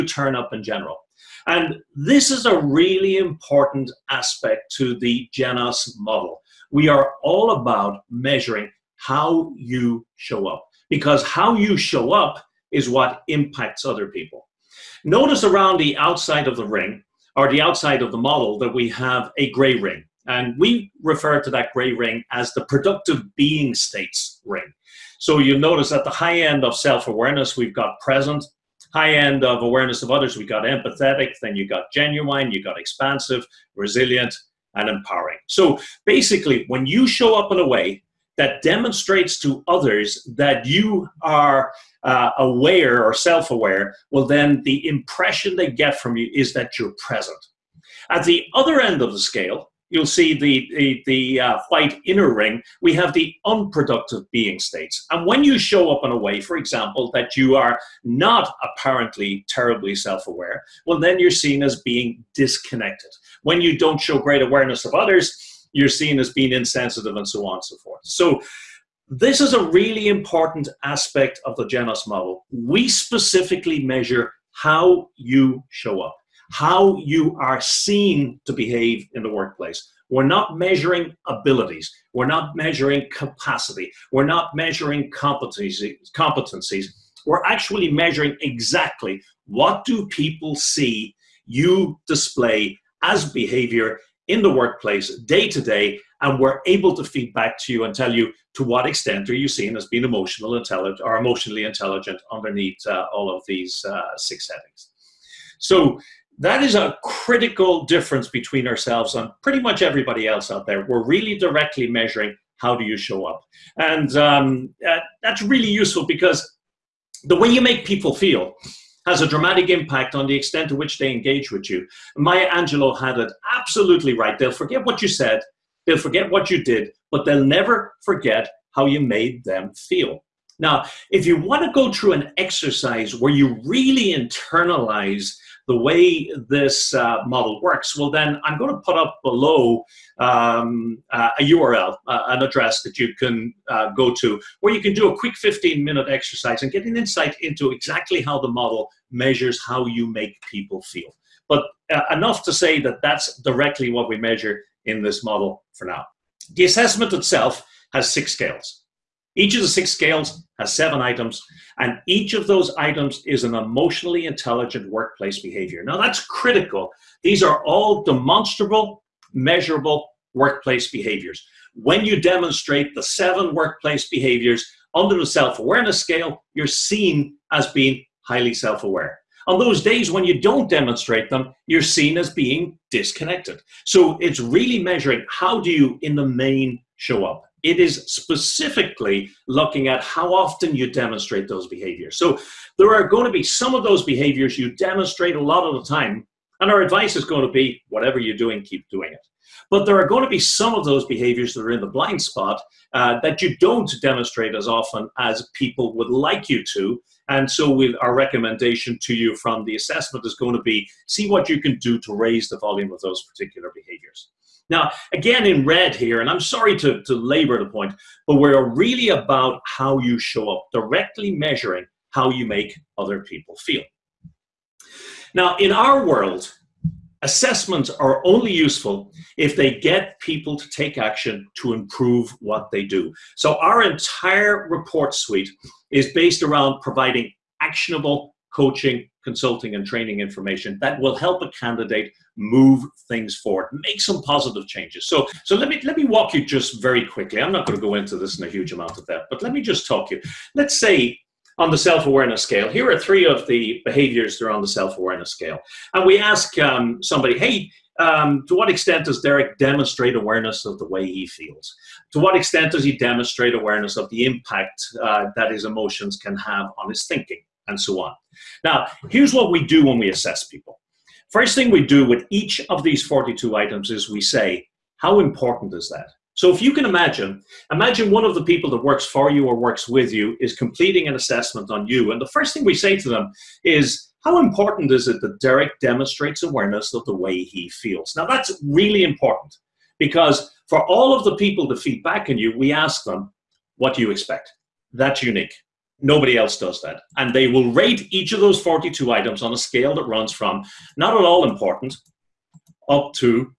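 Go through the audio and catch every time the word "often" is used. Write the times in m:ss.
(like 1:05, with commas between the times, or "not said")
3:10, 3:24.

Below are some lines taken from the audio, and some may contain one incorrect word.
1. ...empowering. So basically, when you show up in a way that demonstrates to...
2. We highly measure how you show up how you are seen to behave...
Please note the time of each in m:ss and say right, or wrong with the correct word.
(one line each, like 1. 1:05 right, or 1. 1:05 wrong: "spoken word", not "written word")
1. 0:34 right
2. 1:12 wrong: "specifically", not "highly".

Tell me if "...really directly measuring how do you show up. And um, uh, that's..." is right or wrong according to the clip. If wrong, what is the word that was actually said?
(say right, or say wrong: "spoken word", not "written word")
right.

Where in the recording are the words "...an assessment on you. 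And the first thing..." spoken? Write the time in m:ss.
4:41.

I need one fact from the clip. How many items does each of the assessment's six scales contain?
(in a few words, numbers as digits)
7.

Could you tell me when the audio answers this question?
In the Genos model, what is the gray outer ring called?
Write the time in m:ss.
0:22.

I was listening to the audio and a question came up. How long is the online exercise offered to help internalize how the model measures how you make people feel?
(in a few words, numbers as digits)
15 minutes.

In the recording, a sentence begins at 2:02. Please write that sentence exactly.
Maya Angelou had it absolutely right.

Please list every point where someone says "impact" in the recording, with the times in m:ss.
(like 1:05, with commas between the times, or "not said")
0:13, 1:59, 4:24.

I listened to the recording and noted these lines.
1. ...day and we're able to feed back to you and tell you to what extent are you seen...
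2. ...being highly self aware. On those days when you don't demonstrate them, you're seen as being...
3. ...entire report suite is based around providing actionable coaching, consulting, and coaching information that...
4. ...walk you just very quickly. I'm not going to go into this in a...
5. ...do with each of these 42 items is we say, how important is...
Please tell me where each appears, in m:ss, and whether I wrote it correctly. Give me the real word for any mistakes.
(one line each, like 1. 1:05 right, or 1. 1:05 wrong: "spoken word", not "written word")
1. 1:35 right
2. 2:57 right
3. 3:53 wrong: "training", not "coaching"
4. 4:06 right
5. 4:31 right.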